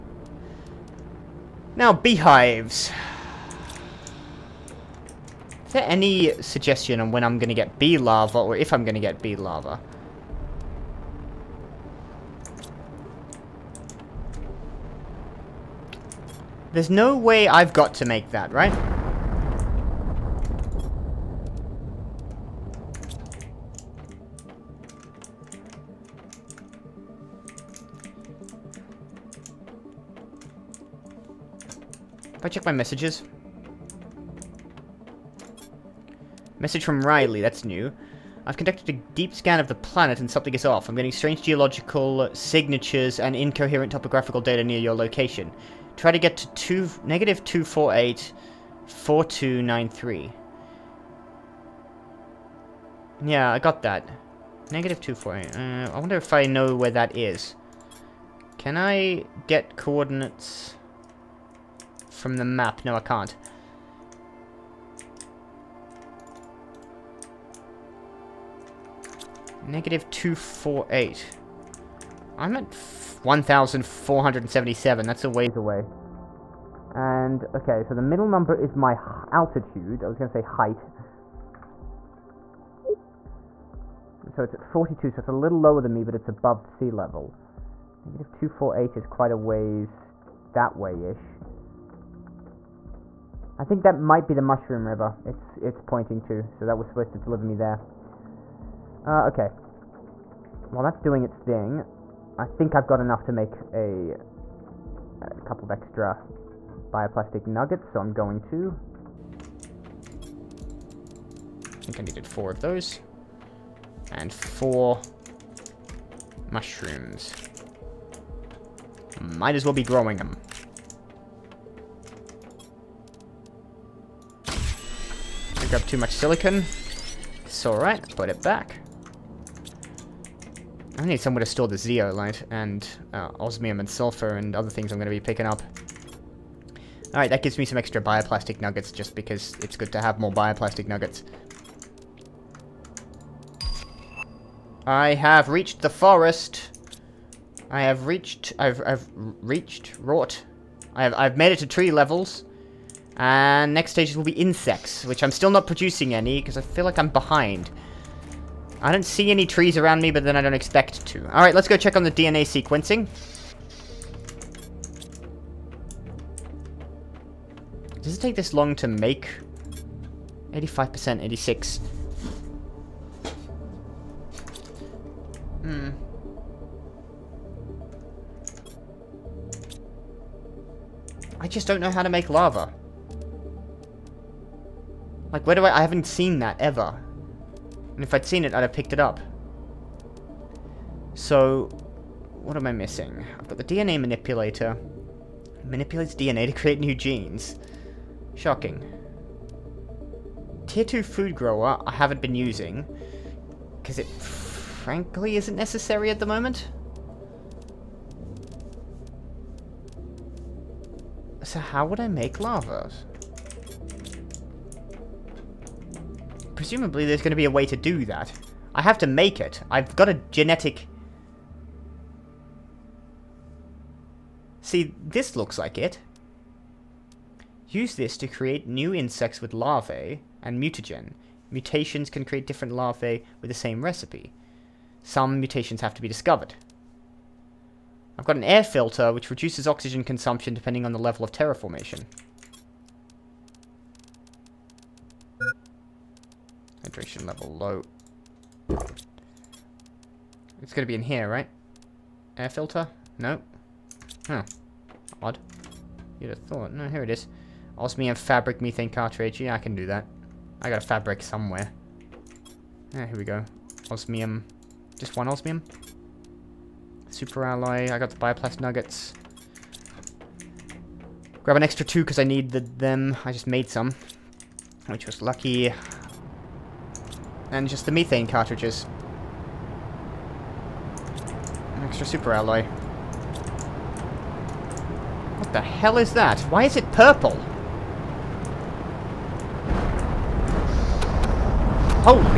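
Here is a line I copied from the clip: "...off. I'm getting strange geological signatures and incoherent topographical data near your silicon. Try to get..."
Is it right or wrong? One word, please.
wrong.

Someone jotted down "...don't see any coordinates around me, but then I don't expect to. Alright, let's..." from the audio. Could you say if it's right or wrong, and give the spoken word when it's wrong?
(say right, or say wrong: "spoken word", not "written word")
wrong: "trees", not "coordinates".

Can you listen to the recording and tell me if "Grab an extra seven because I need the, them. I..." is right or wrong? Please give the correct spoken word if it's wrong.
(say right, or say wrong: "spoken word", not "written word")
wrong: "two", not "seven".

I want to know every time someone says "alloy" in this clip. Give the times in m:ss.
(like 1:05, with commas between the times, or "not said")
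4:27, 4:42.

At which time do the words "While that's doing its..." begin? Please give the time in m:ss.
1:40.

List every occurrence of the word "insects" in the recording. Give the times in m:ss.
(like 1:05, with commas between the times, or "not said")
2:34, 3:48.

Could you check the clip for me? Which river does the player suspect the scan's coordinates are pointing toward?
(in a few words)
Mushroom River.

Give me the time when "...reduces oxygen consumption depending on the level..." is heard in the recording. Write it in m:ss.
3:59.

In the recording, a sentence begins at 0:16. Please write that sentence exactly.
There's no way I've got to make that, right?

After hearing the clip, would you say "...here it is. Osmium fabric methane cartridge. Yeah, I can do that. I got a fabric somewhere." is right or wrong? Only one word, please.
right.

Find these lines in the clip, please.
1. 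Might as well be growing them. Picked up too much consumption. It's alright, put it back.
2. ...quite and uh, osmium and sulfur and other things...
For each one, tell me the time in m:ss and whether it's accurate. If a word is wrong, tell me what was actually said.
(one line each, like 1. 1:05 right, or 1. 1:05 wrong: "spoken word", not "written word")
1. 1:59 wrong: "silicon", not "consumption"
2. 2:11 wrong: "zeolite", not "quite".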